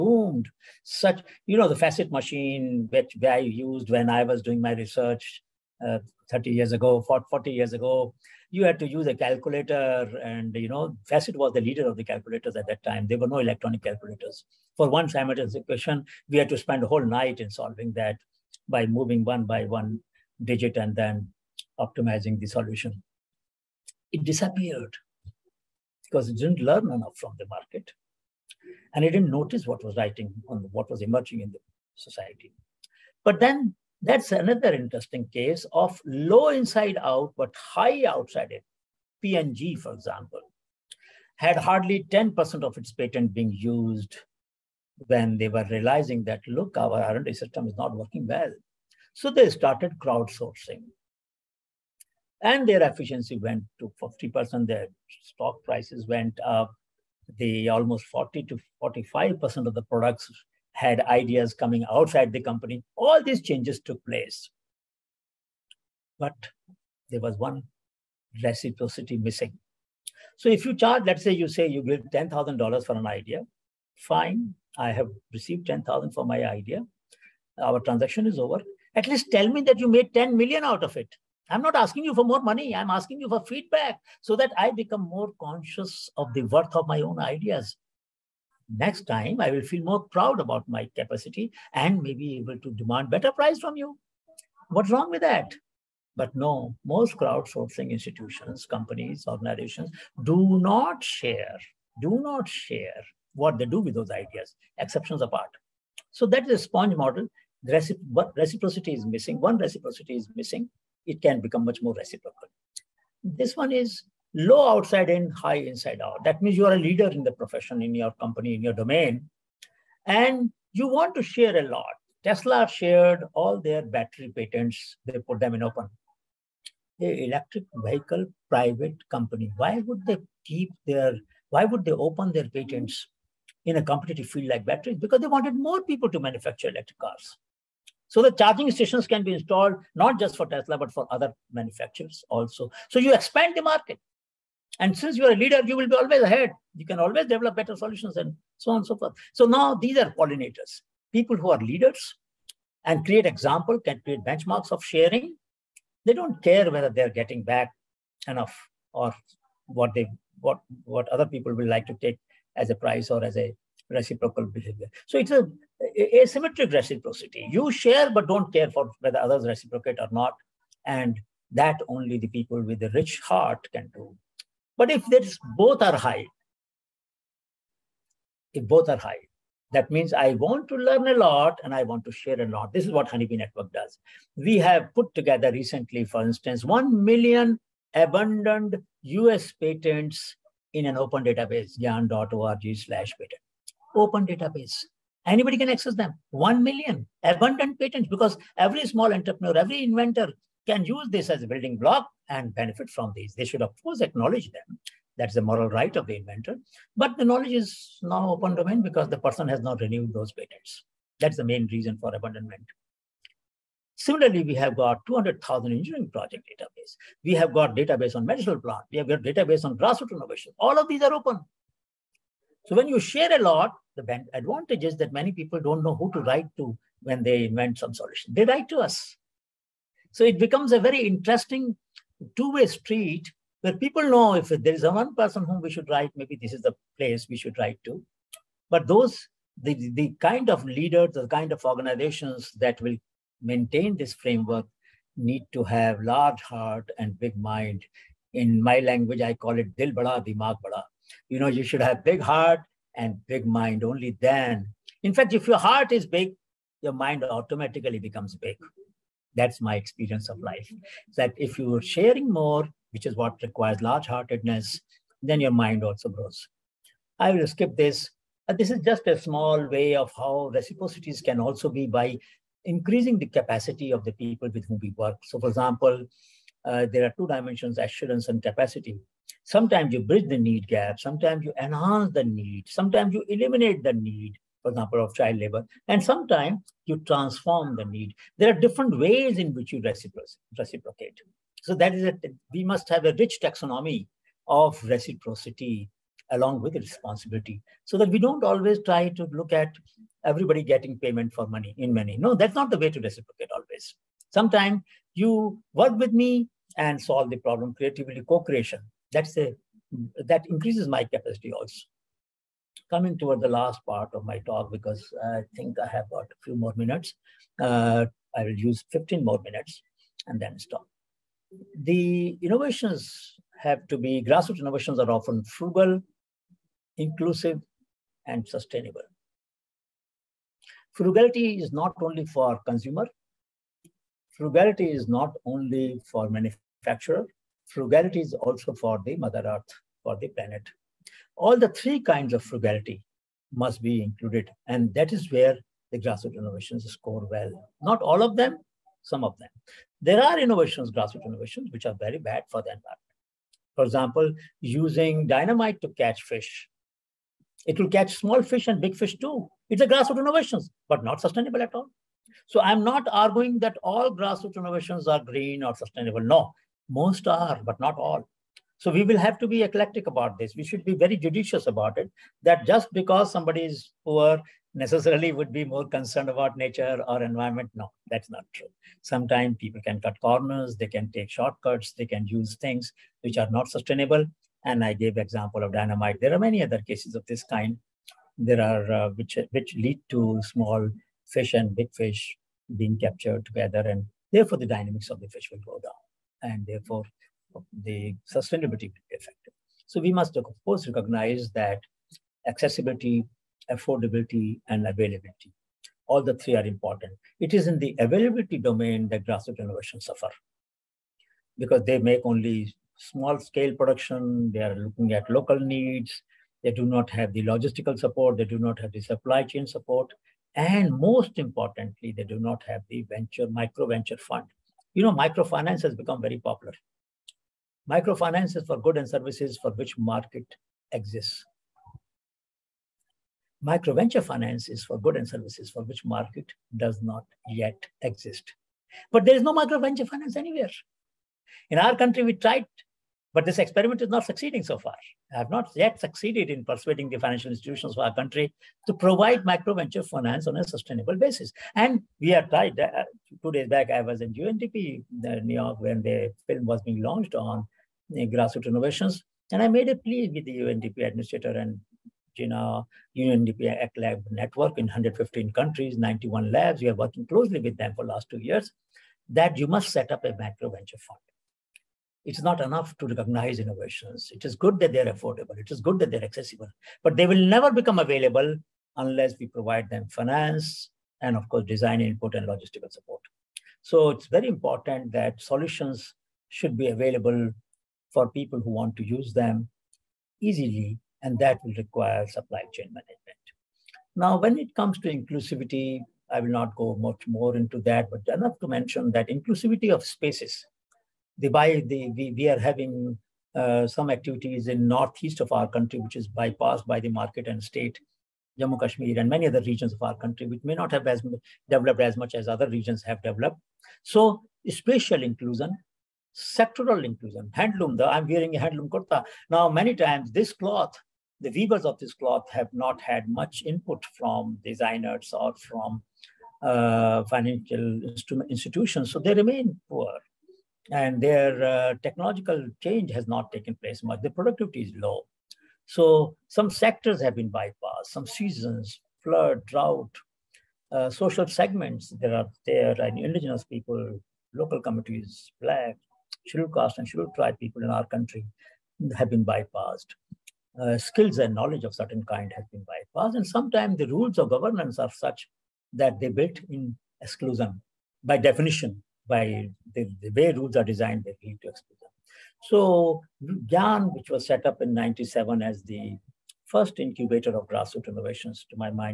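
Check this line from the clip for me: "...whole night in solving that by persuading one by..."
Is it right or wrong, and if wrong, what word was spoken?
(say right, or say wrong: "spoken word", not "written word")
wrong: "moving", not "persuading".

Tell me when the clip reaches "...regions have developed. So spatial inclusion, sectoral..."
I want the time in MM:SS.
08:32.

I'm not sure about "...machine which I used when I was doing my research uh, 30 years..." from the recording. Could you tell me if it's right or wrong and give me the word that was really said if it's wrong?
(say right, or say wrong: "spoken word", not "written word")
right.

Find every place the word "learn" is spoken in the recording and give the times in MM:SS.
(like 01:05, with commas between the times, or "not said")
00:26, 03:00.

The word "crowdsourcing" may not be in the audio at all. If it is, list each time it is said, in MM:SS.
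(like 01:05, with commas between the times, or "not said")
00:50, 01:37.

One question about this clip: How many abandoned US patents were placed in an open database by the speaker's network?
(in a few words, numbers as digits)
1 million.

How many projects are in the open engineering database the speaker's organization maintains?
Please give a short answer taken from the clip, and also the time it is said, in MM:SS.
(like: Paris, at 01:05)
200,000, at 03:35.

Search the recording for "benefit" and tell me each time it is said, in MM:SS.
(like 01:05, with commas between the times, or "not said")
03:22.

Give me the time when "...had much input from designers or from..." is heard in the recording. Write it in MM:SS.
08:43.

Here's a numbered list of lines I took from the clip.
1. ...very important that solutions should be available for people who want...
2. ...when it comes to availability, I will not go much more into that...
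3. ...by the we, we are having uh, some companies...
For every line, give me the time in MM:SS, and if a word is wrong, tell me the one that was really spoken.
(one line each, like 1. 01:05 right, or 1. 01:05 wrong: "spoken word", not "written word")
1. 08:04 right
2. 08:14 wrong: "inclusivity", not "availability"
3. 08:21 wrong: "activities", not "companies".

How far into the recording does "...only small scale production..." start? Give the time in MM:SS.
06:52.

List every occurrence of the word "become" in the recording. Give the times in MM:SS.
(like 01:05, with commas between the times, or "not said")
01:24, 01:51, 03:50, 04:17, 07:05, 07:57.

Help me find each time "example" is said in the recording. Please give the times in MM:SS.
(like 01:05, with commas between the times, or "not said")
00:39, 02:33, 04:35, 04:44, 05:53, 06:25.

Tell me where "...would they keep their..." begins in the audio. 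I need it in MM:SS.
02:09.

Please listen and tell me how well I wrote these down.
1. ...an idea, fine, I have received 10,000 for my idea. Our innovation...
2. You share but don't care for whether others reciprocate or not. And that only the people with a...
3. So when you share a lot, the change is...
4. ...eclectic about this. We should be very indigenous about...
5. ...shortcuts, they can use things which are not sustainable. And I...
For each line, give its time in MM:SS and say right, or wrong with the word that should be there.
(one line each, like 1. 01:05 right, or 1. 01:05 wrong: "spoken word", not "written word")
1. 01:12 wrong: "transaction", not "innovation"
2. 02:47 right
3. 03:42 wrong: "advantage", not "change"
4. 06:09 wrong: "judicious", not "indigenous"
5. 06:21 right.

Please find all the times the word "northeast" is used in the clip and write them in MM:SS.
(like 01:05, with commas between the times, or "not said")
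08:24.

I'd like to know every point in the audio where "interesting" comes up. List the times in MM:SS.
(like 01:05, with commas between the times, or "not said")
00:34, 03:51.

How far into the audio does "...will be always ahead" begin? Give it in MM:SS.
02:25.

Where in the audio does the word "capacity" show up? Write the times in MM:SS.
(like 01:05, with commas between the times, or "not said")
01:30, 04:33, 04:38, 05:11.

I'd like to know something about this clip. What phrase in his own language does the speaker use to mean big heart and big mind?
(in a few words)
dil bada, dimag bada.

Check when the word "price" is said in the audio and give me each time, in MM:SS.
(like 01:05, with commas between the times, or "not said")
00:55, 01:33, 02:42.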